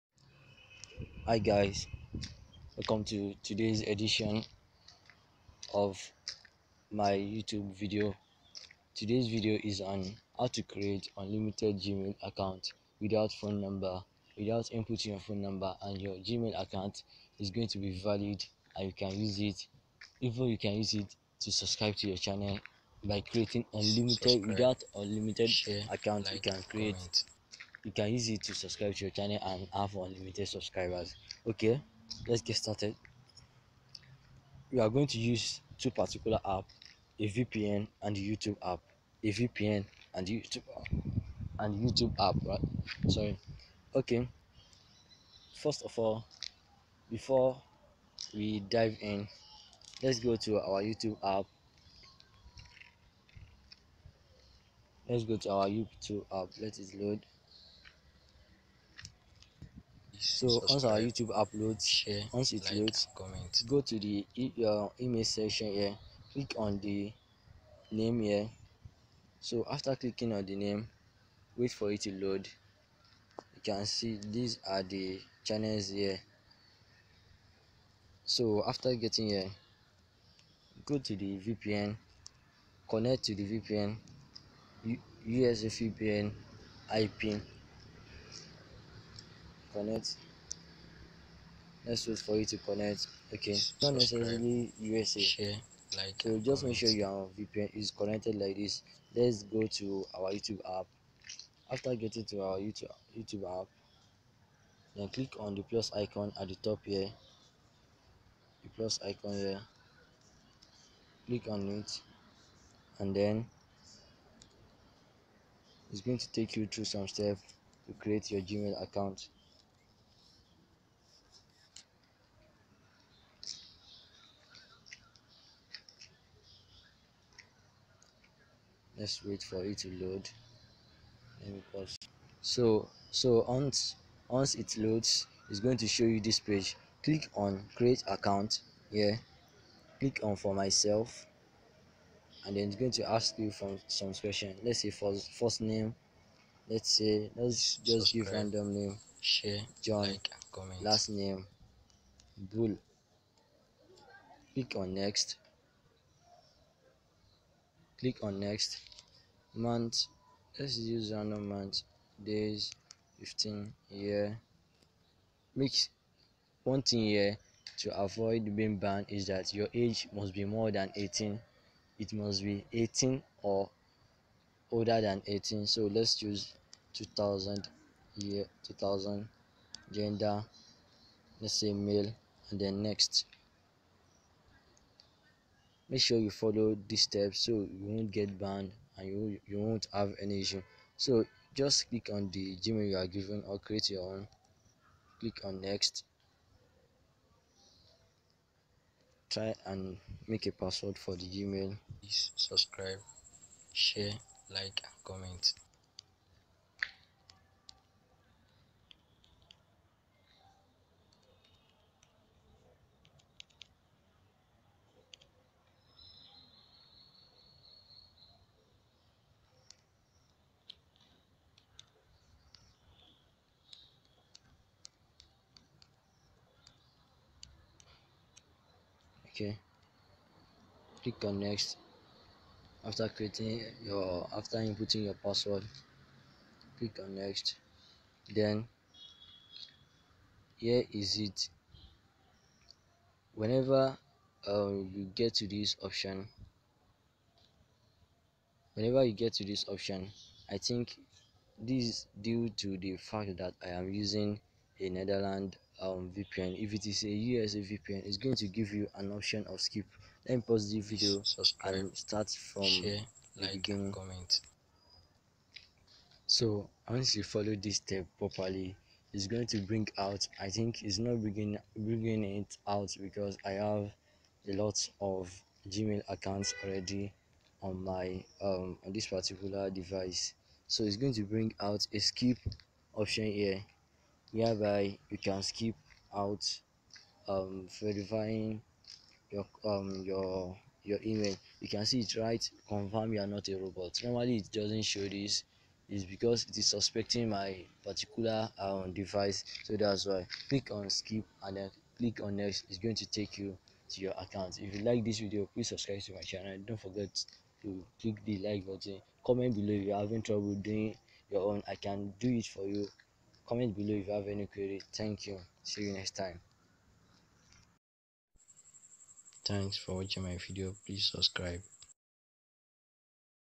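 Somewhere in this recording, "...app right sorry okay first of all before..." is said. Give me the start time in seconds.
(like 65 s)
42 s.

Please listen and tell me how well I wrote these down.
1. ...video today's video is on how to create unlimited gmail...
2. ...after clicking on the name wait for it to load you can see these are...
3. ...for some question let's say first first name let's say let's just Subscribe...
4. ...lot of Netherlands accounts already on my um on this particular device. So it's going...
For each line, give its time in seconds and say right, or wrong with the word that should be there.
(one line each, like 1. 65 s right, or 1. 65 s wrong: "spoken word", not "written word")
1. 7 s right
2. 69 s right
3. 143 s right
4. 274 s wrong: "Gmail", not "Netherlands".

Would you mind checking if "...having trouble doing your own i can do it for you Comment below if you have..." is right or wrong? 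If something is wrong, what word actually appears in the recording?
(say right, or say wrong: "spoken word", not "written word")
right.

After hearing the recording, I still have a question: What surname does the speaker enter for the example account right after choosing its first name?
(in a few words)
Bull.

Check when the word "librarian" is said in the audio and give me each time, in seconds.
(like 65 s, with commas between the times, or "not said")
not said.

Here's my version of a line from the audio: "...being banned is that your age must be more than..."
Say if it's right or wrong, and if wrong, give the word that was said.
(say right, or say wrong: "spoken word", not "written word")
right.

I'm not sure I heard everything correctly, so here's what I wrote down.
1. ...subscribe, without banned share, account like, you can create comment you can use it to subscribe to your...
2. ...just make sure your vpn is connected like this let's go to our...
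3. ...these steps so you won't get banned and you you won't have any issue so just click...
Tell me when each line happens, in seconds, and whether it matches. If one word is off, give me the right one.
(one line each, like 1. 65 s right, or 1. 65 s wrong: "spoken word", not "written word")
1. 24 s wrong: "unlimited", not "banned"
2. 96 s right
3. 186 s right.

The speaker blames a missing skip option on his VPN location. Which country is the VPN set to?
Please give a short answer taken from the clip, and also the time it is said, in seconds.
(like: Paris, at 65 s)
Netherlands, at 254 s.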